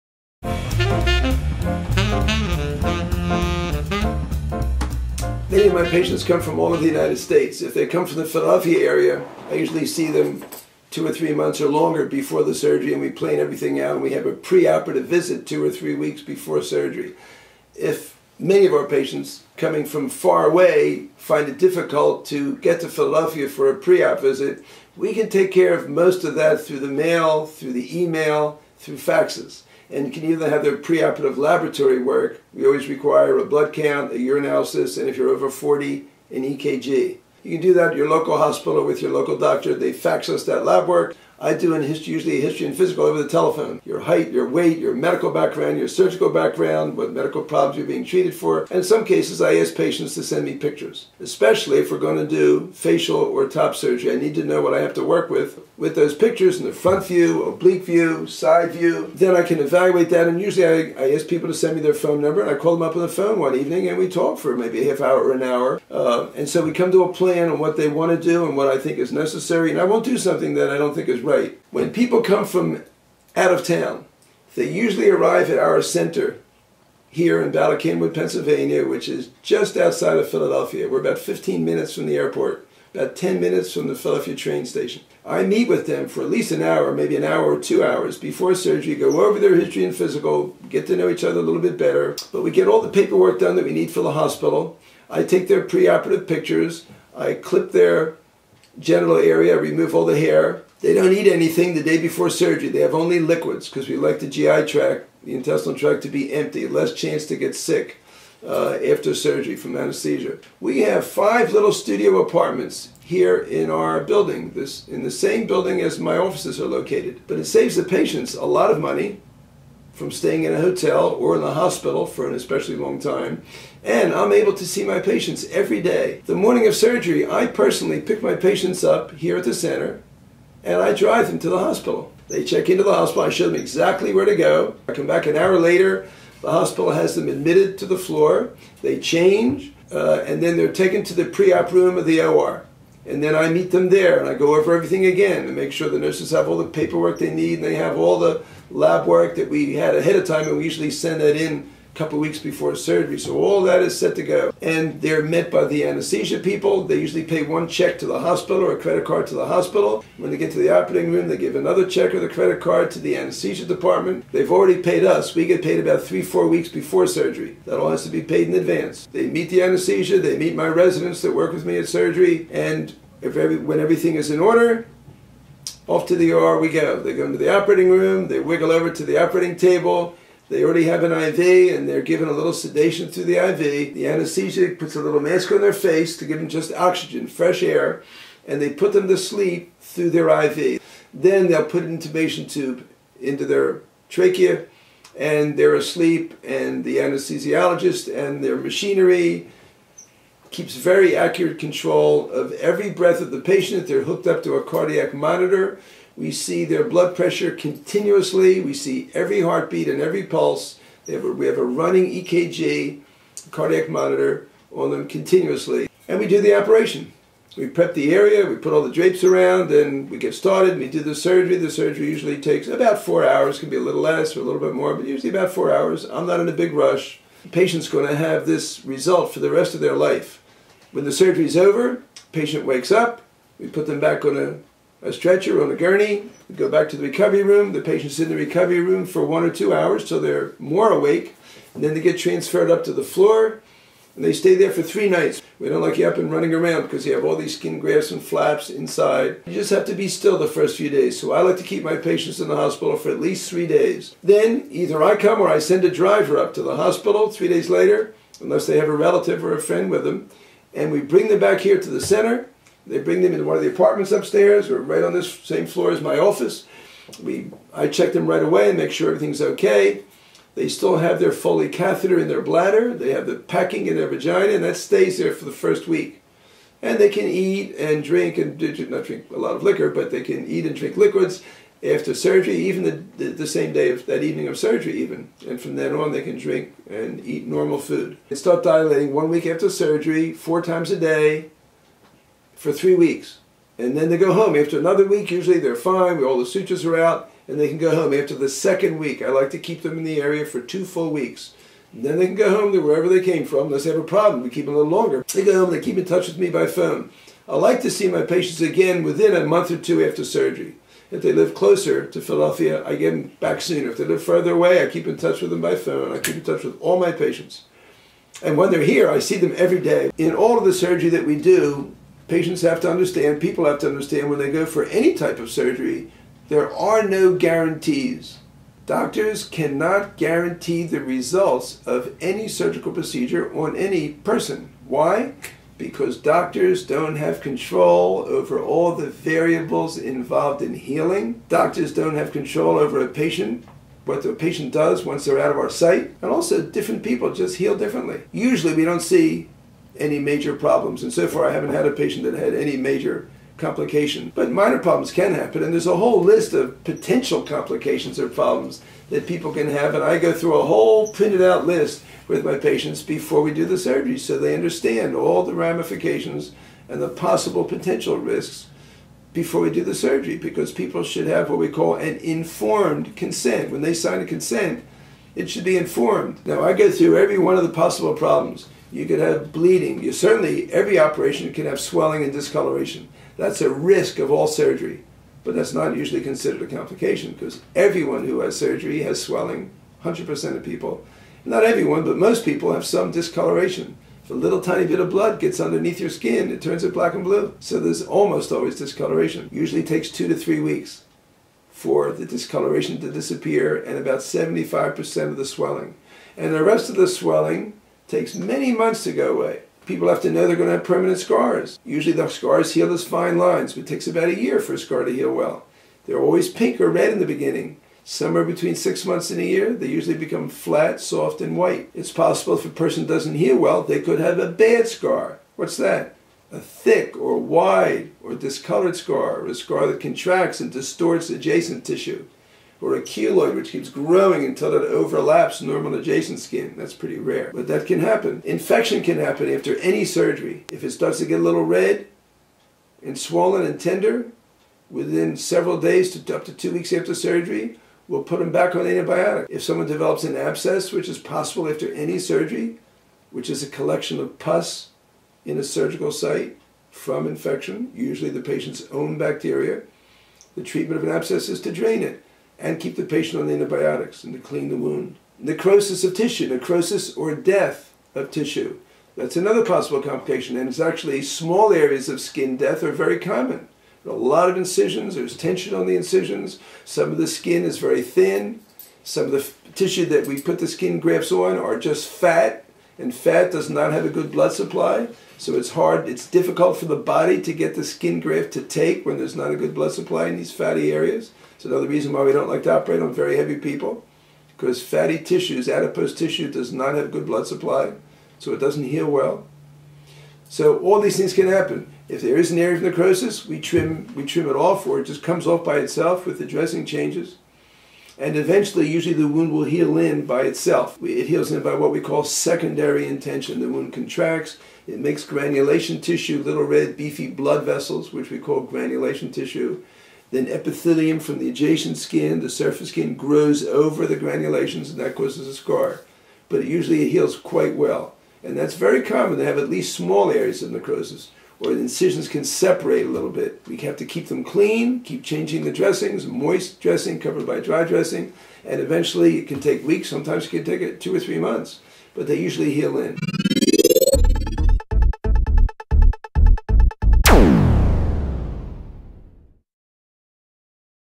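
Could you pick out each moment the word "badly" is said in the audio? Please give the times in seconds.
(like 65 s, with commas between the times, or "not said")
not said.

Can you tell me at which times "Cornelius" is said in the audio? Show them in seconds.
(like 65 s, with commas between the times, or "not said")
not said.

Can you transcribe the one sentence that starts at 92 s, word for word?
But we get all the paperwork done that we need for the hospital.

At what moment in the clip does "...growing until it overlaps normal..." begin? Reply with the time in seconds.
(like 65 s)
433 s.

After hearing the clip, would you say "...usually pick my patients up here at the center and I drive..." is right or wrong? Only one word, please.
wrong.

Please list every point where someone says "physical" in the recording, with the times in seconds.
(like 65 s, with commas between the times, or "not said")
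42 s, 89 s.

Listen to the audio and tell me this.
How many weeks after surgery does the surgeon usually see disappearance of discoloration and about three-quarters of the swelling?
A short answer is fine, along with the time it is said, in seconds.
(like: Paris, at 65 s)
2 to 3 weeks, at 400 s.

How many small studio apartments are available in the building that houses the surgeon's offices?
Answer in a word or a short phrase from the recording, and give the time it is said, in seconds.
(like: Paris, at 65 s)
5, at 111 s.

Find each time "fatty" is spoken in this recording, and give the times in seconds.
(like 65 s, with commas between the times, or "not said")
490 s, 494 s.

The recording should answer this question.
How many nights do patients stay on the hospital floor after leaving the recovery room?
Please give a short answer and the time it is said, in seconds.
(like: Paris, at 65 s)
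3, at 244 s.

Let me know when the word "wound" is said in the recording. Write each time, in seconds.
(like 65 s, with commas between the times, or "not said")
464 s, 509 s, 513 s.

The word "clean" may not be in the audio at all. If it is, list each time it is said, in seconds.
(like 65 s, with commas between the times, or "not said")
464 s, 534 s.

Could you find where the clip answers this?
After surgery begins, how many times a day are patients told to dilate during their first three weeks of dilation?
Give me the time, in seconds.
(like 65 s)
290 s.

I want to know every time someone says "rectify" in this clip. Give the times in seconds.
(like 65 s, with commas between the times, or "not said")
not said.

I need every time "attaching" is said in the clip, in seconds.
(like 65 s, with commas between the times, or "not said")
not said.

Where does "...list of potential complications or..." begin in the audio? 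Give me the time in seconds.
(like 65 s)
356 s.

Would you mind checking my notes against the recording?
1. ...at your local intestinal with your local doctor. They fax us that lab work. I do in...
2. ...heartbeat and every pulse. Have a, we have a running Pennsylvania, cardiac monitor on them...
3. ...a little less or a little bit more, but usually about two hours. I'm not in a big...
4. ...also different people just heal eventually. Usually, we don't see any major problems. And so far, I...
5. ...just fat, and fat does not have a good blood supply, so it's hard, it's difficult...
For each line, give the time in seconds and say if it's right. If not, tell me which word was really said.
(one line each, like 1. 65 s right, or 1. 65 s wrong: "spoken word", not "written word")
1. 37 s wrong: "hospital", not "intestinal"
2. 209 s wrong: "EKG", not "Pennsylvania"
3. 223 s wrong: "four", not "two"
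4. 346 s wrong: "differently", not "eventually"
5. 481 s right.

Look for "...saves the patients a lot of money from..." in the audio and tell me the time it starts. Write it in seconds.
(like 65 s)
117 s.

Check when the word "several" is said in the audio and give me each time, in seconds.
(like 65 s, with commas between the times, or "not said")
445 s.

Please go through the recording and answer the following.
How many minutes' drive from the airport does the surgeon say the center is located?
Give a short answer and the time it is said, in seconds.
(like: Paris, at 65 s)
15, at 81 s.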